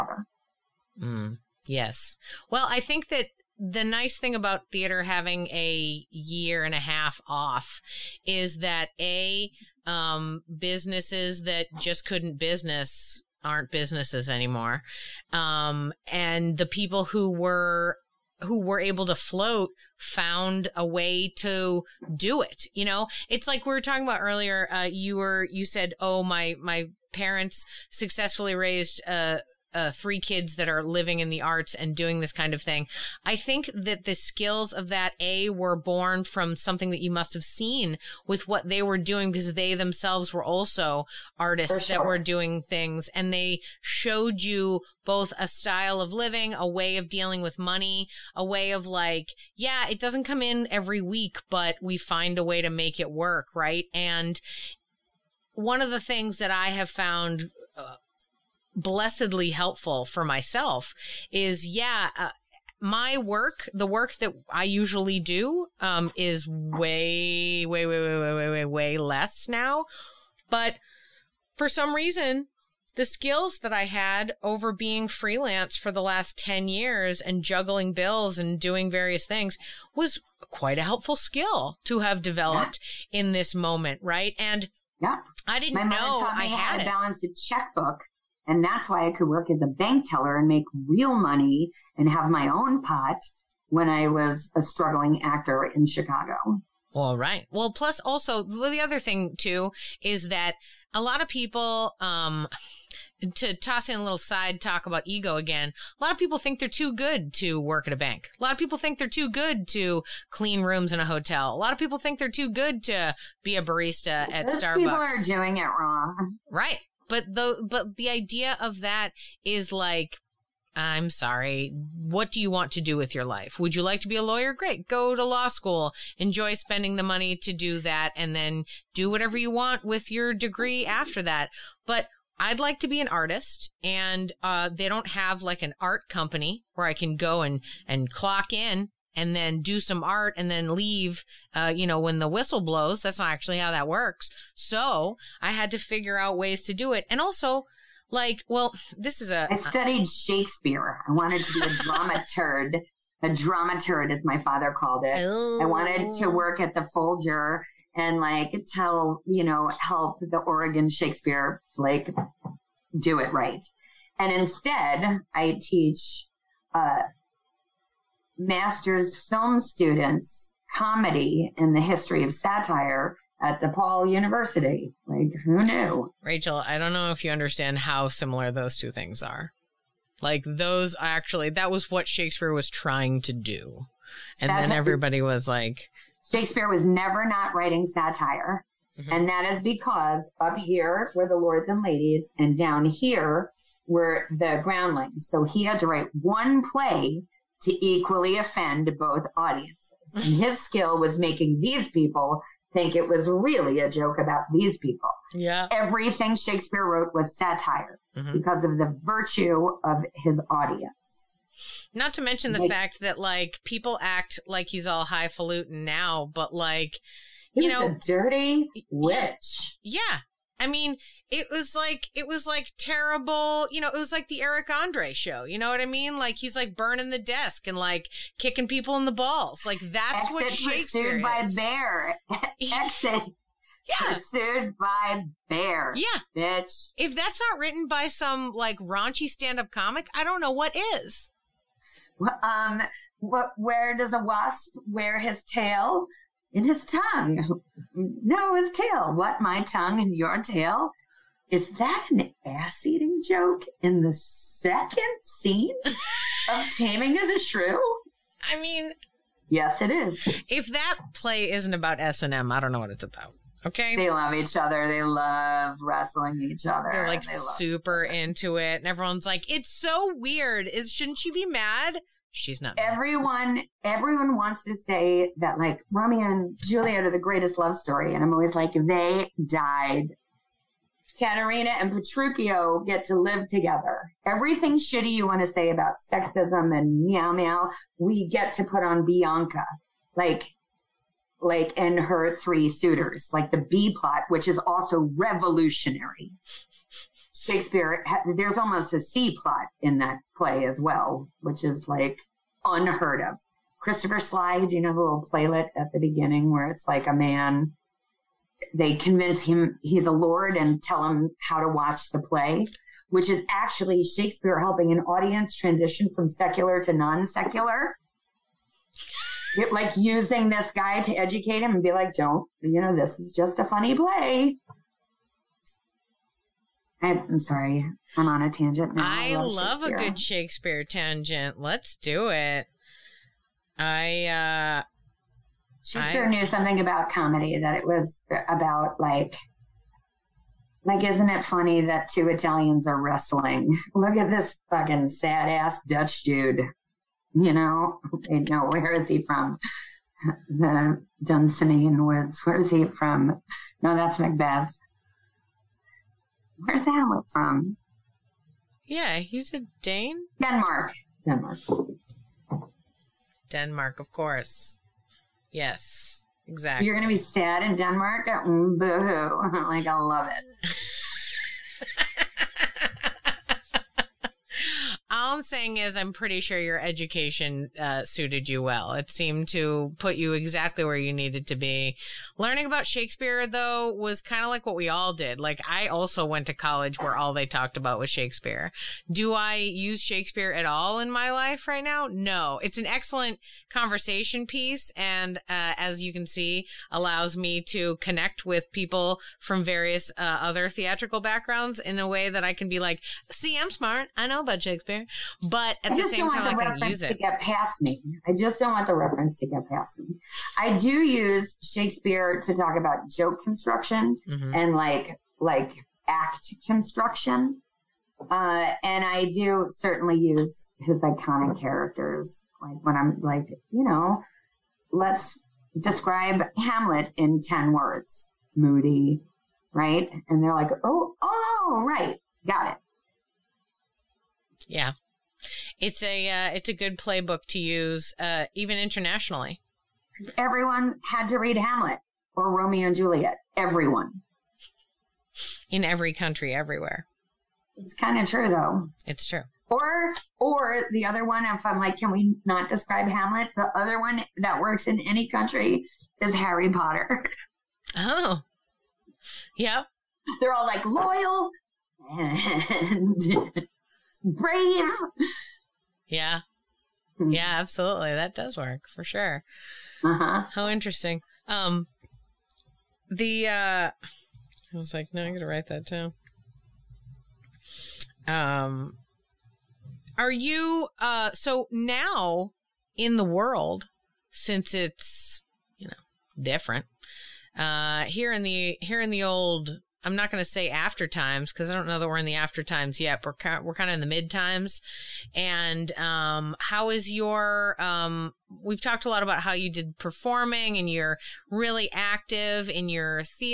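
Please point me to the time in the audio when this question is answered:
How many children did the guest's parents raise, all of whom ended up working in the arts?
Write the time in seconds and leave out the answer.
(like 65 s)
29 s.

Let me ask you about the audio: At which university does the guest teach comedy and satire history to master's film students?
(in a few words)
DePaul University.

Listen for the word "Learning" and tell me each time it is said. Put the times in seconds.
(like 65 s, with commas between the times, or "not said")
382 s.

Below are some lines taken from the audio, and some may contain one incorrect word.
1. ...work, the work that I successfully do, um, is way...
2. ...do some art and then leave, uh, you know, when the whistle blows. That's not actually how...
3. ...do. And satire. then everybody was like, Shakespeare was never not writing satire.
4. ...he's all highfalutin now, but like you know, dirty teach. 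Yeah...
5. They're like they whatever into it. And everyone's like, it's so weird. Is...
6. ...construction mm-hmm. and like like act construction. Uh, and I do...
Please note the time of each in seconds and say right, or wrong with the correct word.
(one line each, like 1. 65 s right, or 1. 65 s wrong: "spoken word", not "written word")
1. 63 s wrong: "usually", not "successfully"
2. 139 s right
3. 183 s right
4. 214 s wrong: "witch", not "teach"
5. 266 s wrong: "super", not "whatever"
6. 413 s right.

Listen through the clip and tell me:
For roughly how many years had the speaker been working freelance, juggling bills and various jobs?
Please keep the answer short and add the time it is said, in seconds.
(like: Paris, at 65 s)
10, at 76 s.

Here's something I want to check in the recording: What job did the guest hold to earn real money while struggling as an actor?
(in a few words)
Bank teller.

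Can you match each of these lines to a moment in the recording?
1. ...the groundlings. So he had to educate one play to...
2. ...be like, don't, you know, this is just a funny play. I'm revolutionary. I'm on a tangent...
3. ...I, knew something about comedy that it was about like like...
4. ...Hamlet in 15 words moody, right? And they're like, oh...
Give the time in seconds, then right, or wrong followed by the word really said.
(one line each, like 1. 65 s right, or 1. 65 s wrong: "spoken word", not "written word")
1. 194 s wrong: "write", not "educate"
2. 321 s wrong: "sorry", not "revolutionary"
3. 336 s right
4. 426 s wrong: "10", not "15".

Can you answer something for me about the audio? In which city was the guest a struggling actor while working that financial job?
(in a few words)
Chicago.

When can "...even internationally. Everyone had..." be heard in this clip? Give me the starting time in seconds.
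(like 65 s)
438 s.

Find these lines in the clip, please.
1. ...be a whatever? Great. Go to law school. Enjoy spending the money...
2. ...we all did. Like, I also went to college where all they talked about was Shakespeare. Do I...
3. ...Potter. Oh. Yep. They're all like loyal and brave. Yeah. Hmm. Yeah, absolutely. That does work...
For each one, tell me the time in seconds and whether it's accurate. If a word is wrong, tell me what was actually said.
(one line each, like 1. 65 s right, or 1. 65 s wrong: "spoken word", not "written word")
1. 124 s wrong: "lawyer", not "whatever"
2. 384 s right
3. 456 s right.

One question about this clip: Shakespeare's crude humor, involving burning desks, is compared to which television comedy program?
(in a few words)
The Eric Andre Show.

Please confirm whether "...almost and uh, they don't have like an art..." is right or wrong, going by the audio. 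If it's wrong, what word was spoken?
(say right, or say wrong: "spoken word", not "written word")
wrong: "artist", not "almost".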